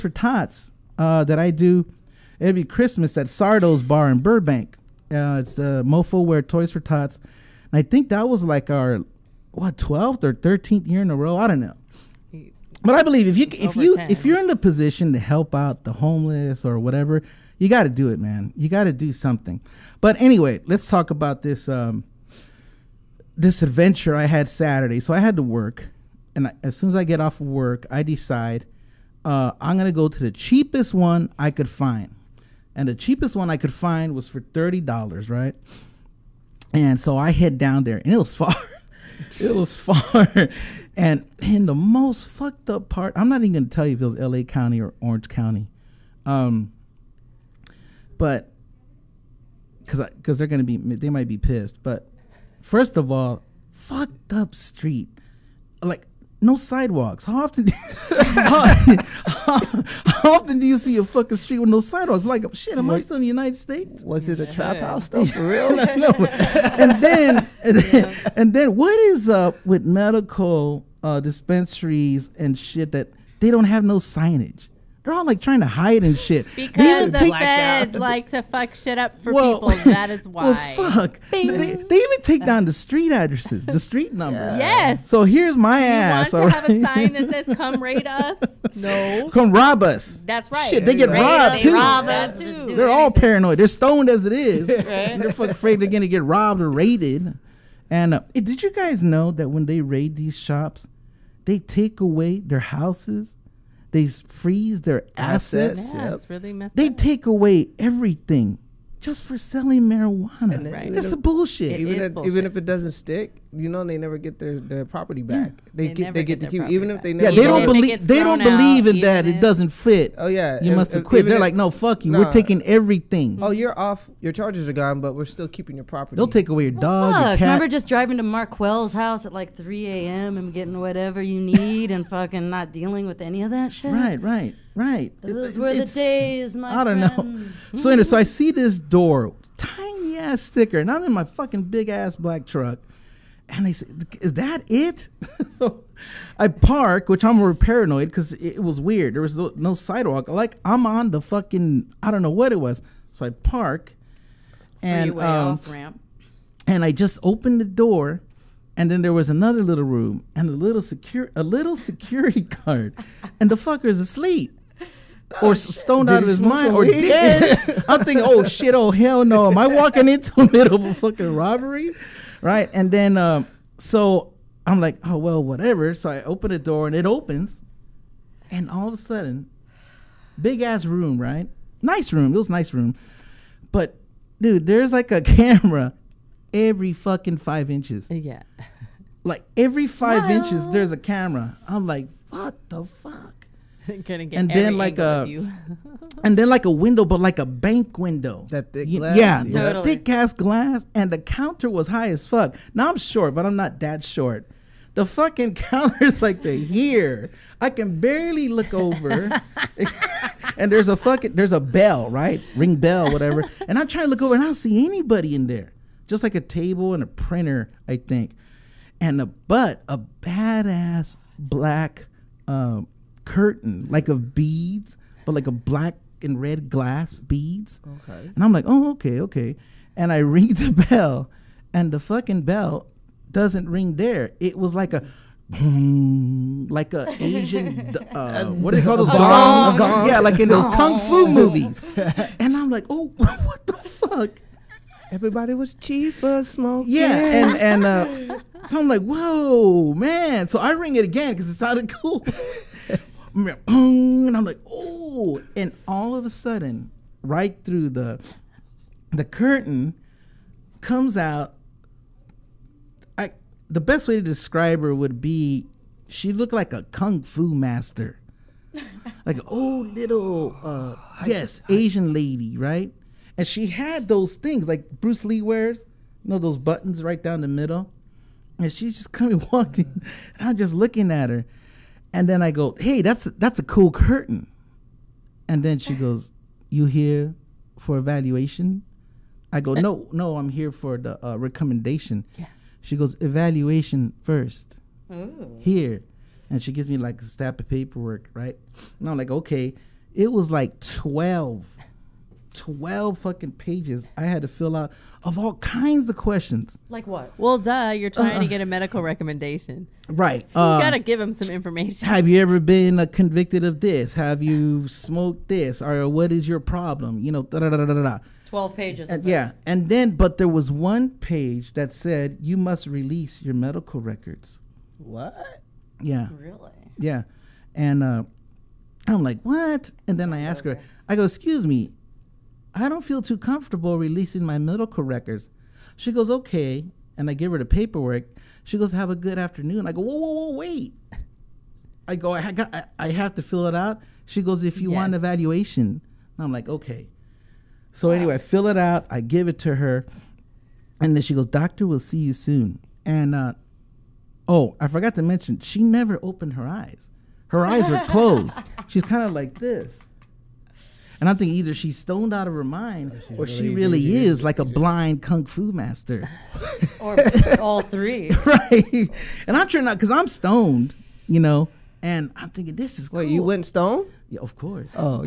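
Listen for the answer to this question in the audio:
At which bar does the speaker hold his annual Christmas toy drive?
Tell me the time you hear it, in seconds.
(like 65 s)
3 s.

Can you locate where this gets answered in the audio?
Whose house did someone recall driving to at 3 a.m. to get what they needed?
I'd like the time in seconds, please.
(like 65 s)
128 s.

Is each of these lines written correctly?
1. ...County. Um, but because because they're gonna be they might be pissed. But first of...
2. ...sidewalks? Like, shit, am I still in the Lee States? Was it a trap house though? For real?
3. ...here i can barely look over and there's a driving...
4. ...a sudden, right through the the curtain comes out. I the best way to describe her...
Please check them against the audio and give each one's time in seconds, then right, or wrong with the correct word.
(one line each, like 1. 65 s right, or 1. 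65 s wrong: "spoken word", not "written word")
1. 45 s right
2. 61 s wrong: "United", not "Lee"
3. 206 s wrong: "fucking", not "driving"
4. 256 s right.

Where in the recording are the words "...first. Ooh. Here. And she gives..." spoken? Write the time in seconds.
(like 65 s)
294 s.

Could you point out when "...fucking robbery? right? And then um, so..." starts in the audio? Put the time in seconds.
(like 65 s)
170 s.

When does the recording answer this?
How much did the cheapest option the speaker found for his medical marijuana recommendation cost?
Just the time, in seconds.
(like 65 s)
34 s.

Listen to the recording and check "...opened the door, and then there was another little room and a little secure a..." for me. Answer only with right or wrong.
right.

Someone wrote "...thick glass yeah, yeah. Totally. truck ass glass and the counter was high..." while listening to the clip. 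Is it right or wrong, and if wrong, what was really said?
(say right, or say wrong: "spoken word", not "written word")
wrong: "thick", not "truck".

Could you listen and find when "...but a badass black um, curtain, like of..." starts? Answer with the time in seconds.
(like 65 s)
219 s.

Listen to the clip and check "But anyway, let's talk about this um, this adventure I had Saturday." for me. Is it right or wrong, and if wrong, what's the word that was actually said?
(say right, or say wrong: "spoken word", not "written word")
right.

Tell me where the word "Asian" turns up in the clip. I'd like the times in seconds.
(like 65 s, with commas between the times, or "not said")
237 s, 271 s.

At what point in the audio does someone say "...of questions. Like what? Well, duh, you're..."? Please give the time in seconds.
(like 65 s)
306 s.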